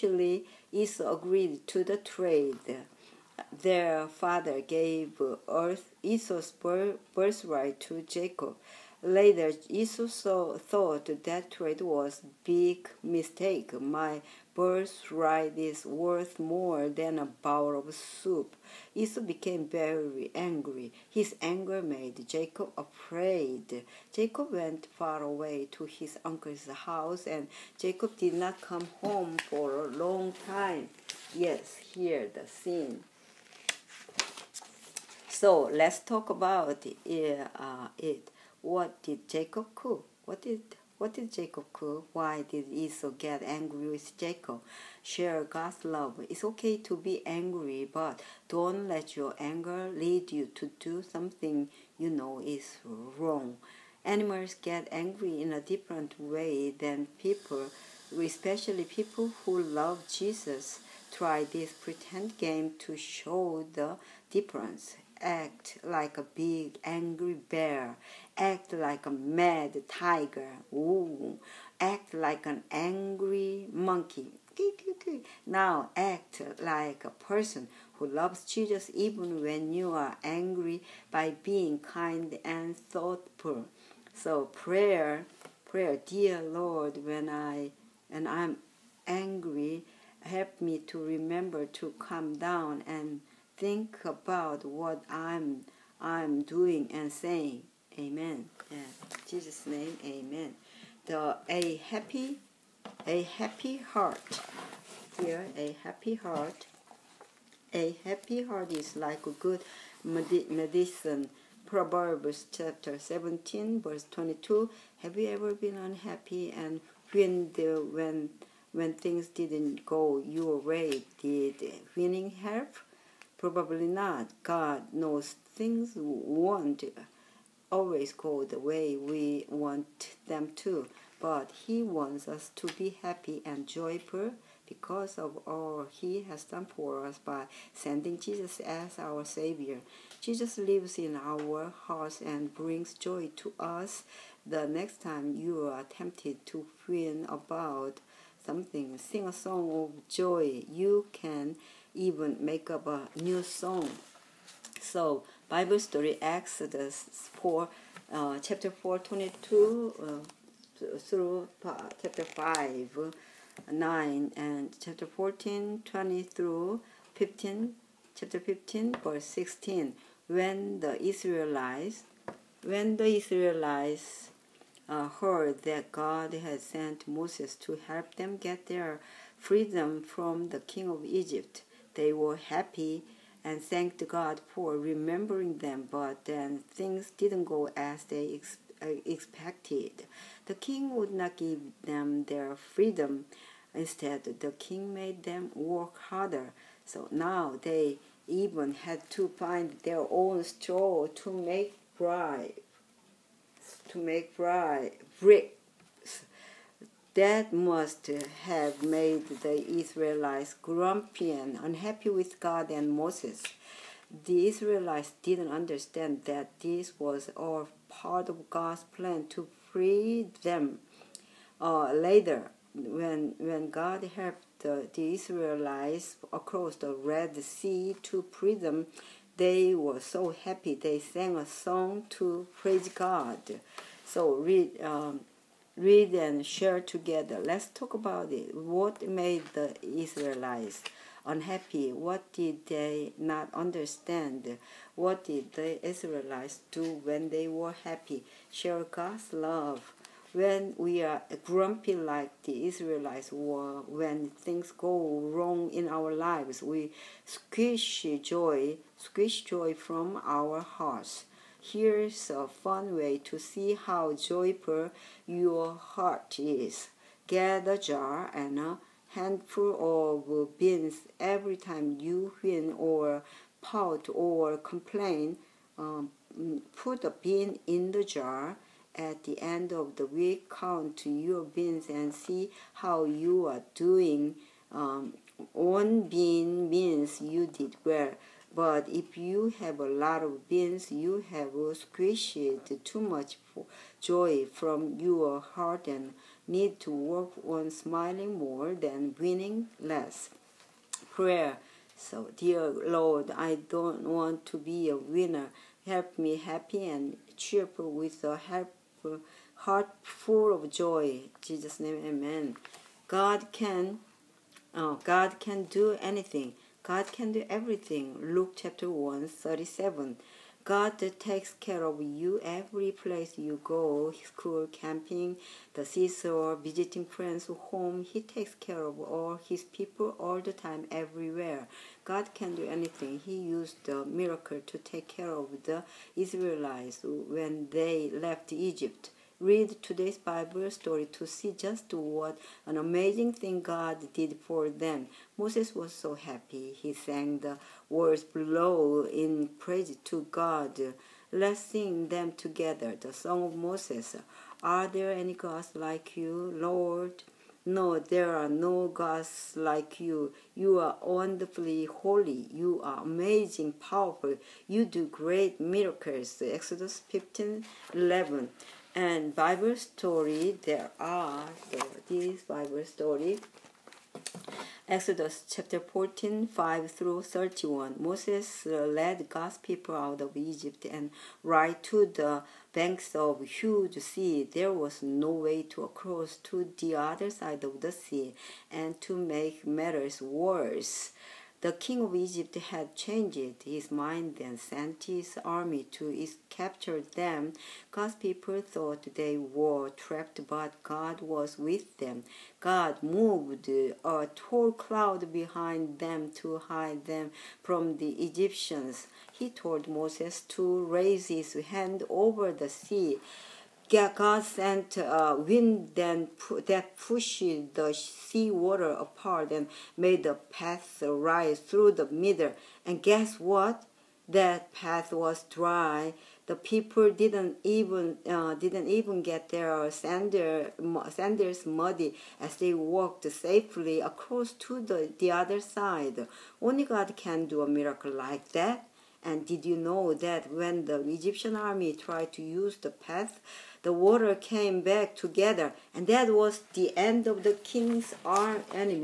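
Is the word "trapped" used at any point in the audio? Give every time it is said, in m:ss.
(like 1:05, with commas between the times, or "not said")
6:39.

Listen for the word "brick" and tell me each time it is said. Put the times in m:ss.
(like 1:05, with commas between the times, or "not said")
3:25.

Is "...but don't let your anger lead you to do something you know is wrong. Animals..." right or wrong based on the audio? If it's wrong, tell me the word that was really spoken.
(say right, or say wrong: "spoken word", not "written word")
right.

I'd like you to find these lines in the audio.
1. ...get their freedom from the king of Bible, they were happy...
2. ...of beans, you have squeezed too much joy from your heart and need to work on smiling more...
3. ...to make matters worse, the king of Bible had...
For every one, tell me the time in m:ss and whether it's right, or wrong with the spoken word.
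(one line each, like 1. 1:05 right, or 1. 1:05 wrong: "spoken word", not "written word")
1. 2:58 wrong: "Egypt", not "Bible"
2. 4:50 right
3. 6:29 wrong: "Egypt", not "Bible".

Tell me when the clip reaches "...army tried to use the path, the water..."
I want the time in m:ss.
7:21.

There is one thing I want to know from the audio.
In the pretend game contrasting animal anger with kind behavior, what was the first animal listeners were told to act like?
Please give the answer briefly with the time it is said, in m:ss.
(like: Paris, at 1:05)
big angry bear, at 1:06.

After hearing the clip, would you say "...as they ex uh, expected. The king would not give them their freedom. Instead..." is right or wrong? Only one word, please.
right.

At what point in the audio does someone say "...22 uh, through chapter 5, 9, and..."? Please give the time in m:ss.
2:38.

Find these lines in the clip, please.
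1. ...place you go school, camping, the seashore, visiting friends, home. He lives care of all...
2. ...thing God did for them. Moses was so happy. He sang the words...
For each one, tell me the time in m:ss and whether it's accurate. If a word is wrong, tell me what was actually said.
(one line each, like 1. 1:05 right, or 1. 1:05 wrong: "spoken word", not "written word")
1. 5:22 wrong: "takes", not "lives"
2. 5:43 right.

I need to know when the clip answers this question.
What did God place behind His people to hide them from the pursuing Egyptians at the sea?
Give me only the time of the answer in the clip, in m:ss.
6:43.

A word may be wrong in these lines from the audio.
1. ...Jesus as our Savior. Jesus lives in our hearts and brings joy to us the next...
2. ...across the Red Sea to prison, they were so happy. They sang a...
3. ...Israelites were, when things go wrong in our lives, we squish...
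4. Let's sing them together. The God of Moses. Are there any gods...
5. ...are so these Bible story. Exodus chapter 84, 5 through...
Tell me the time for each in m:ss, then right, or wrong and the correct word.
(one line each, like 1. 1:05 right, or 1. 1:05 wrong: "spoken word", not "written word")
1. 2:18 right
2. 3:46 right
3. 4:12 right
4. 5:51 wrong: "Song", not "God"
5. 6:10 wrong: "14", not "84".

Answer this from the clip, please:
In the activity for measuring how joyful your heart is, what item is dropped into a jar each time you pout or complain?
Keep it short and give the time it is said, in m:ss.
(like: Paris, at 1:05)
a bean, at 4:37.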